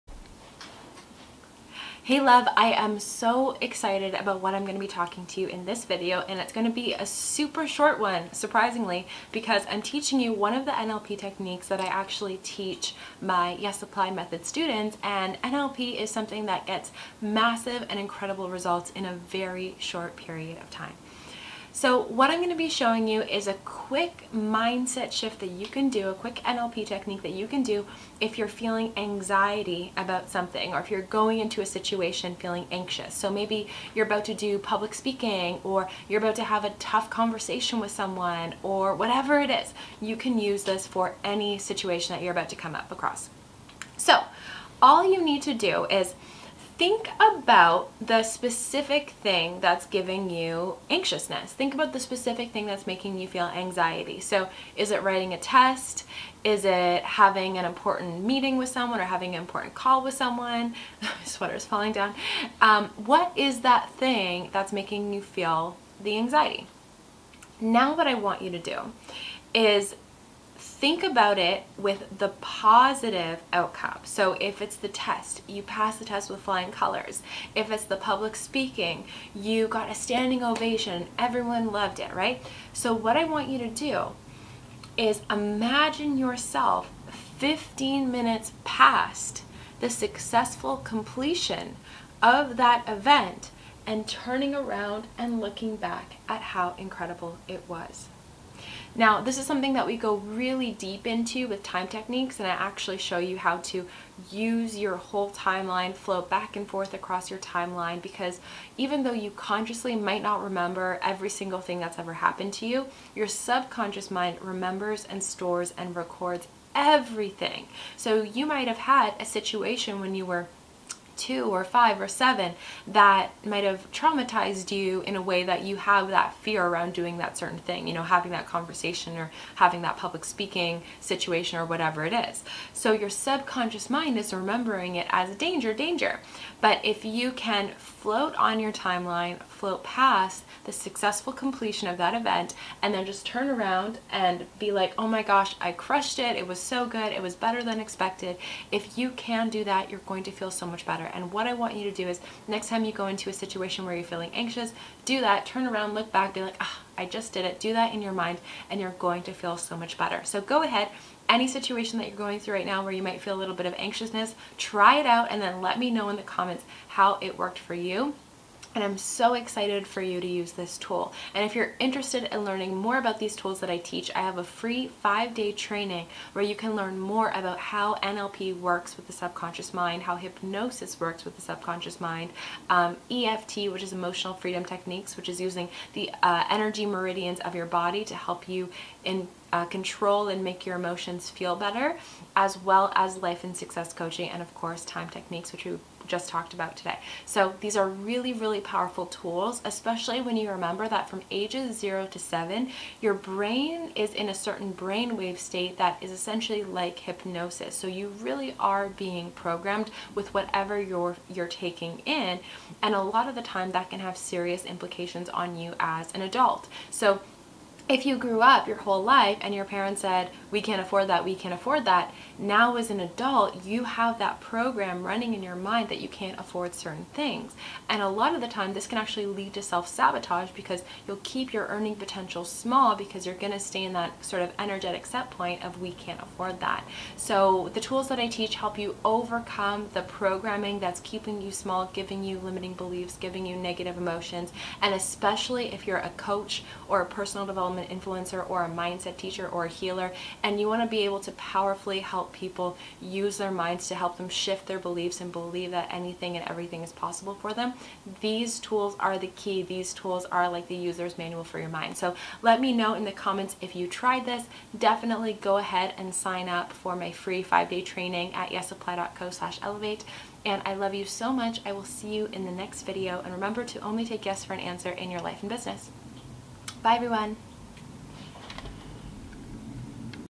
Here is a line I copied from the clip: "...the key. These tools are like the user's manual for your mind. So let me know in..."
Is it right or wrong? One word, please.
right.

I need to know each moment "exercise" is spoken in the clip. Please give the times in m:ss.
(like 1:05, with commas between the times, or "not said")
not said.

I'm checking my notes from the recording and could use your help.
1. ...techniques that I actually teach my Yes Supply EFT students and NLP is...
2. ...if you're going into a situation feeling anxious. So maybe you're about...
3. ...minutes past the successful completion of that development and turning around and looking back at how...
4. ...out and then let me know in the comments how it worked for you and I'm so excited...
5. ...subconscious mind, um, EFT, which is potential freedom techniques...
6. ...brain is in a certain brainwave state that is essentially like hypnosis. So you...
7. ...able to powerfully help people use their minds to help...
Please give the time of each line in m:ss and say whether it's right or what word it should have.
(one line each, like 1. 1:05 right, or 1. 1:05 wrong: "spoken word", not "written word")
1. 0:11 wrong: "Method", not "EFT"
2. 0:30 right
3. 1:28 wrong: "event", not "development"
4. 2:45 right
5. 3:01 wrong: "emotional", not "potential"
6. 3:23 right
7. 4:10 right.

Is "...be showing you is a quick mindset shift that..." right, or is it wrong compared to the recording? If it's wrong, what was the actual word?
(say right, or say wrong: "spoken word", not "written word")
right.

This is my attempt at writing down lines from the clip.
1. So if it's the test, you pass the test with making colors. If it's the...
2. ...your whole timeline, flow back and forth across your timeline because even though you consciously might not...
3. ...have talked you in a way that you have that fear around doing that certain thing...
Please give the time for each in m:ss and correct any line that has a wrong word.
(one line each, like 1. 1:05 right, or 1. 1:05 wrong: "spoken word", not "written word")
1. 1:14 wrong: "flying", not "making"
2. 1:44 right
3. 2:03 wrong: "traumatized", not "talked".